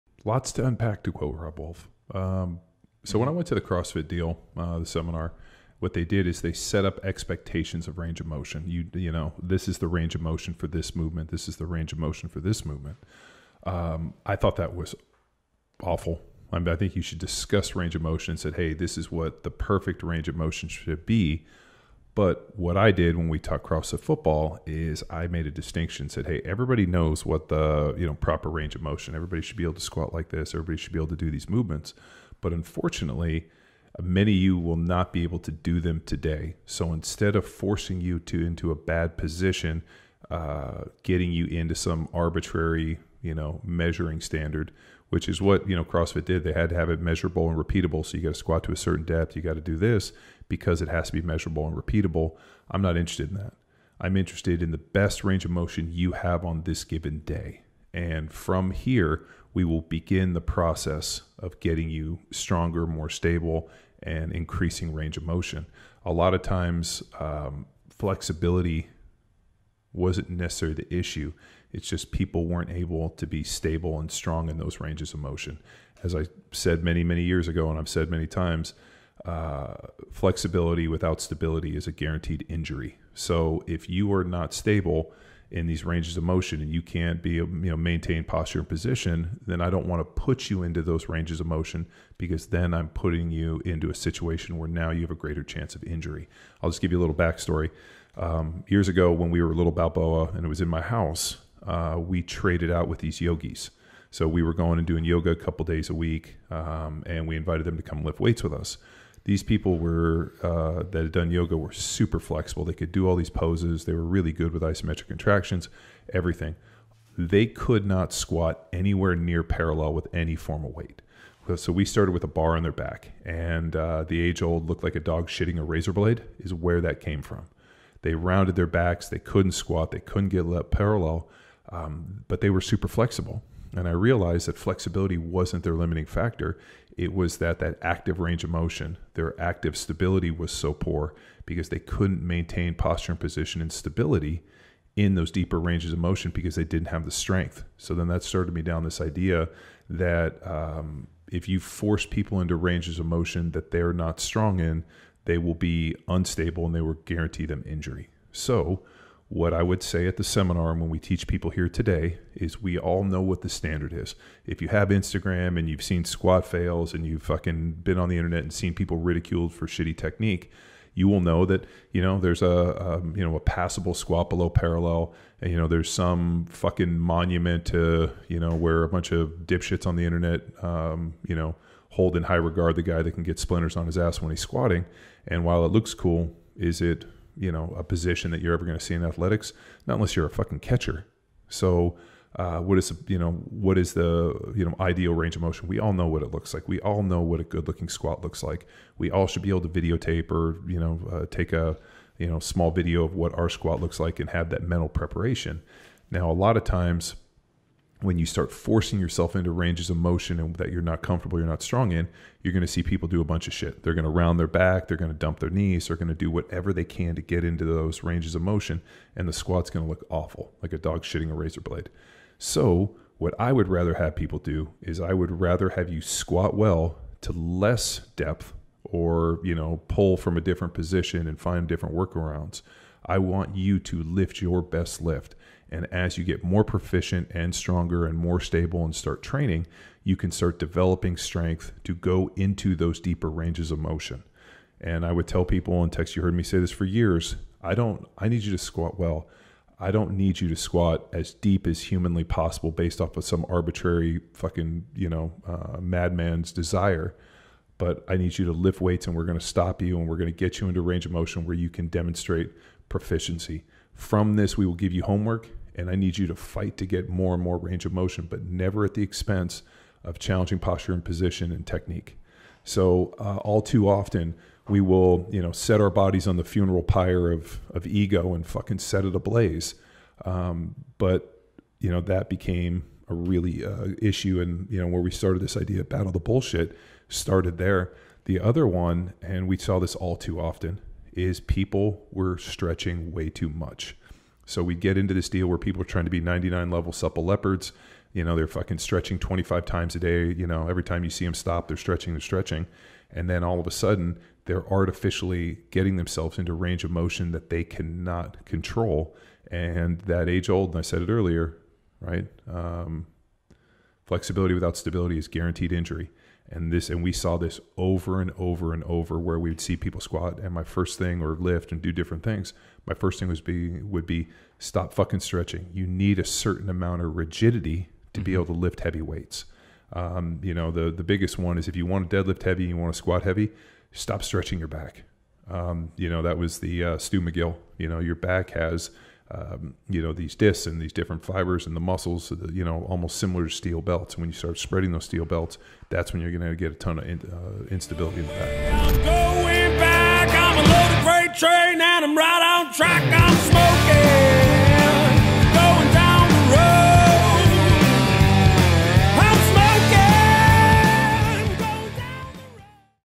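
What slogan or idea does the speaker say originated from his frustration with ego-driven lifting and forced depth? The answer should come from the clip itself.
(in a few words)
Battle the bullshit.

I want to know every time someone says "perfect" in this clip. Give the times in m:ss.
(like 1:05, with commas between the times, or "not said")
0:19.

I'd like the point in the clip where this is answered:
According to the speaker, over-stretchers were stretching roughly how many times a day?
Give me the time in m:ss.
4:59.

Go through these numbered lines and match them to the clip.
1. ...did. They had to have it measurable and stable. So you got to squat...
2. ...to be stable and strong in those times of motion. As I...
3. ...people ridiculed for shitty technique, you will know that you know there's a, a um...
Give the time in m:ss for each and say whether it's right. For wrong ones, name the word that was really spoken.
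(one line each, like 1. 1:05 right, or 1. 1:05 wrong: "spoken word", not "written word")
1. 0:46 wrong: "repeatable", not "stable"
2. 1:13 wrong: "ranges", not "times"
3. 2:48 right.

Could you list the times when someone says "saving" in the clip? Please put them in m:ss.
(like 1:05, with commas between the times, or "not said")
not said.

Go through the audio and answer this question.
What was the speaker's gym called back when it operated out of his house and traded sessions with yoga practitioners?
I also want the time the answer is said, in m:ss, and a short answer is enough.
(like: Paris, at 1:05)
Balboa, at 1:39.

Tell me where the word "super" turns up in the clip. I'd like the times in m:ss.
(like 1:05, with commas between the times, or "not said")
1:51, 2:12.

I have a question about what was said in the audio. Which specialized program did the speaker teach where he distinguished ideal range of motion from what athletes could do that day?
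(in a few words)
CrossFit football.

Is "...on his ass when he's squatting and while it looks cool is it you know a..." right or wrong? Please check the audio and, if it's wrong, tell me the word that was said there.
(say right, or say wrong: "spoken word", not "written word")
right.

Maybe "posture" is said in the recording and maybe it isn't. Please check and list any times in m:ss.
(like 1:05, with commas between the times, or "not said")
1:28, 2:22, 4:30.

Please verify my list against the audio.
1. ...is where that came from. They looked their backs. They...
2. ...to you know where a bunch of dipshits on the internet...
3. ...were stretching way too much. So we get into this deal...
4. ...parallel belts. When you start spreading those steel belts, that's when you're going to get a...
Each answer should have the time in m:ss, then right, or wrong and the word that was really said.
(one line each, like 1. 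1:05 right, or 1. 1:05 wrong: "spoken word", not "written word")
1. 2:06 wrong: "rounded", not "looked"
2. 2:57 right
3. 4:52 right
4. 5:43 wrong: "steel", not "parallel".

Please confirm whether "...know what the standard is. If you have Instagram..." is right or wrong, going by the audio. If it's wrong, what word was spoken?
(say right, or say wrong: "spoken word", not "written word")
right.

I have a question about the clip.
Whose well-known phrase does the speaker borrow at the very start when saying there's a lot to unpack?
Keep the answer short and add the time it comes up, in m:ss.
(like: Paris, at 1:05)
Robb Wolf, at 0:01.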